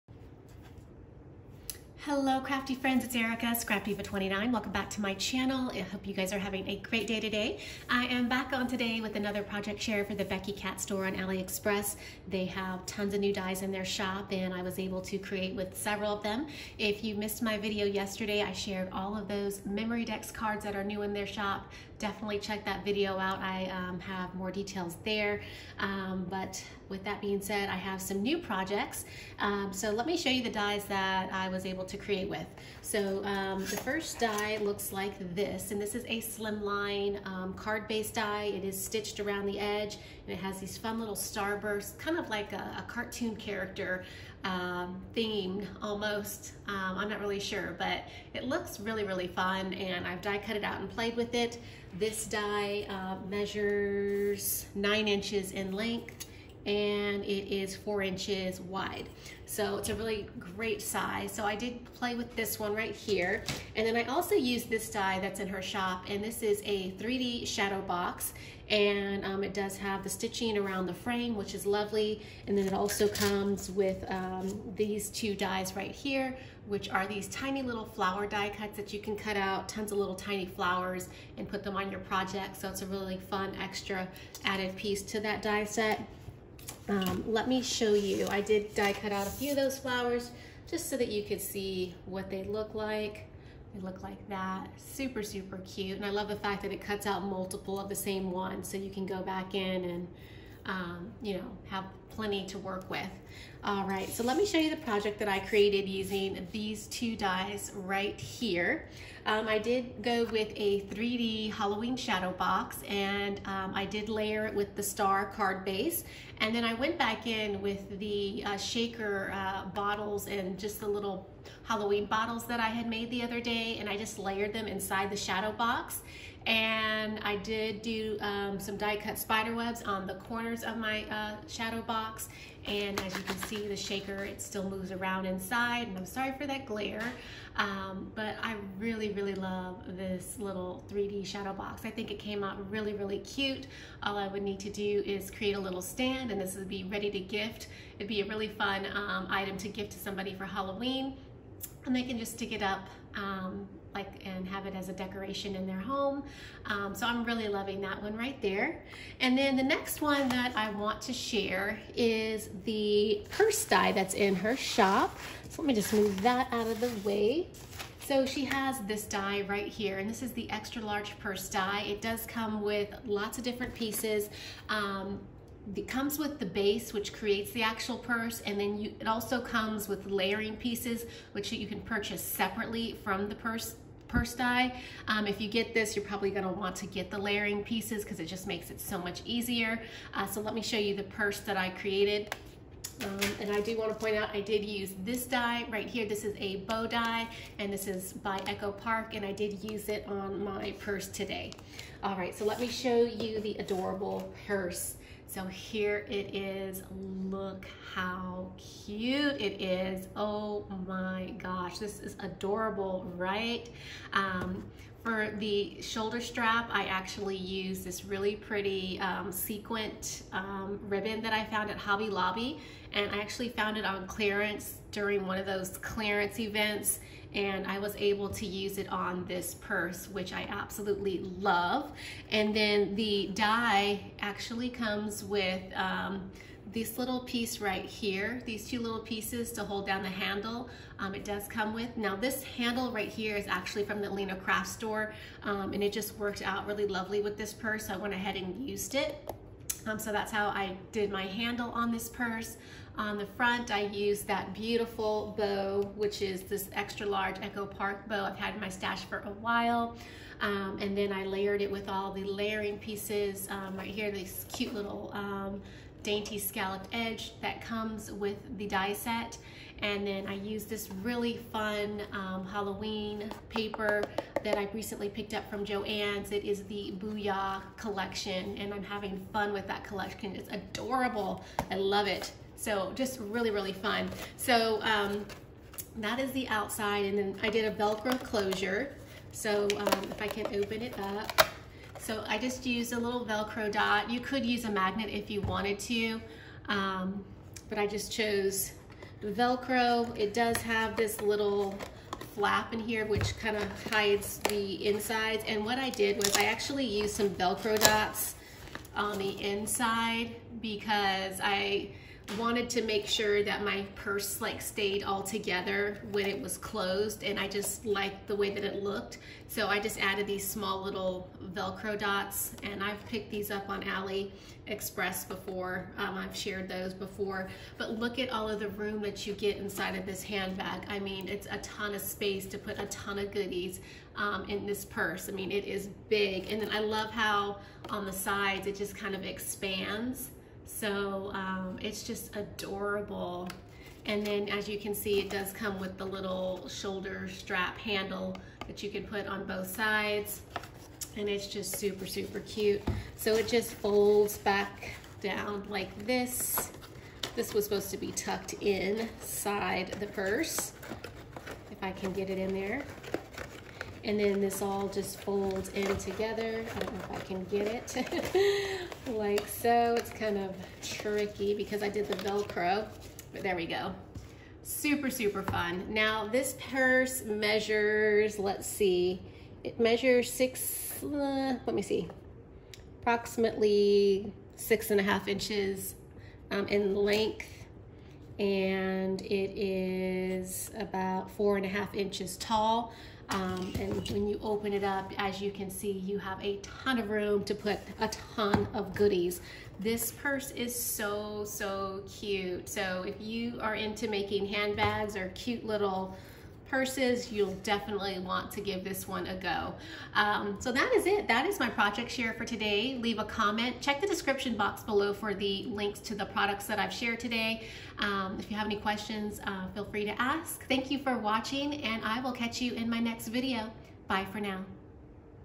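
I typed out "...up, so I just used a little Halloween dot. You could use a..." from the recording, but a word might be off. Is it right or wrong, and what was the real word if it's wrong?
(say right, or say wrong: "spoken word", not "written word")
wrong: "Velcro", not "Halloween".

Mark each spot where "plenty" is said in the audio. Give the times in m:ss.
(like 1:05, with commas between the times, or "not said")
1:42.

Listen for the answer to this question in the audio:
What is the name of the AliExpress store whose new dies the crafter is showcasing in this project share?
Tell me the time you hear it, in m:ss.
0:10.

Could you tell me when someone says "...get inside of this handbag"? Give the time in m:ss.
5:29.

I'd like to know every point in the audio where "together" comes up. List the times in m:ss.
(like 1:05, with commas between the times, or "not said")
5:15, 6:05.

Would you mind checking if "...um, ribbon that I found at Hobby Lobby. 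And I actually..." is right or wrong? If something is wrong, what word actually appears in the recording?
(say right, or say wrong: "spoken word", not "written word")
right.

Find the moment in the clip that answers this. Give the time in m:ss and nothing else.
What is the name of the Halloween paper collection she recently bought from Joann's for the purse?
4:36.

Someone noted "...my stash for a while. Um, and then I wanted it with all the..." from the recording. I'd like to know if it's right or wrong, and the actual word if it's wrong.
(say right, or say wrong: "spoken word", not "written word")
wrong: "layered", not "wanted".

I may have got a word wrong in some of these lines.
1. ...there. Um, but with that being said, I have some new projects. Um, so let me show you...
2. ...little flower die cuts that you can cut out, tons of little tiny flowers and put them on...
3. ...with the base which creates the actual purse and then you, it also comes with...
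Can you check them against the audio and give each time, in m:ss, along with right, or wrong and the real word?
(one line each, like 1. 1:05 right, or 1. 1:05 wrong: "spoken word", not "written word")
1. 0:25 right
2. 1:17 right
3. 2:56 right.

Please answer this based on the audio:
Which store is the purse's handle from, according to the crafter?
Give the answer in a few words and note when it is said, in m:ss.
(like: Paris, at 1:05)
Lena Craft Store, at 4:04.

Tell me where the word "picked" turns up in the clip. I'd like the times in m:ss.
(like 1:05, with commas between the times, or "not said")
4:35, 5:23.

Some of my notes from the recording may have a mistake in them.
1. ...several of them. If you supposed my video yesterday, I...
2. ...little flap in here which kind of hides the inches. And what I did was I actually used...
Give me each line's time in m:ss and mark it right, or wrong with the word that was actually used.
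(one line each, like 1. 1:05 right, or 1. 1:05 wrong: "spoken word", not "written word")
1. 0:15 wrong: "missed", not "supposed"
2. 5:01 wrong: "insides", not "inches".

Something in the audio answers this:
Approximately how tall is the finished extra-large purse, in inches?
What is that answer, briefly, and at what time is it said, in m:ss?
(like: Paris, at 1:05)
4.5 inches, at 6:31.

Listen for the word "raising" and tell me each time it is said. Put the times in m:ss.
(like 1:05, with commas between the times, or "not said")
not said.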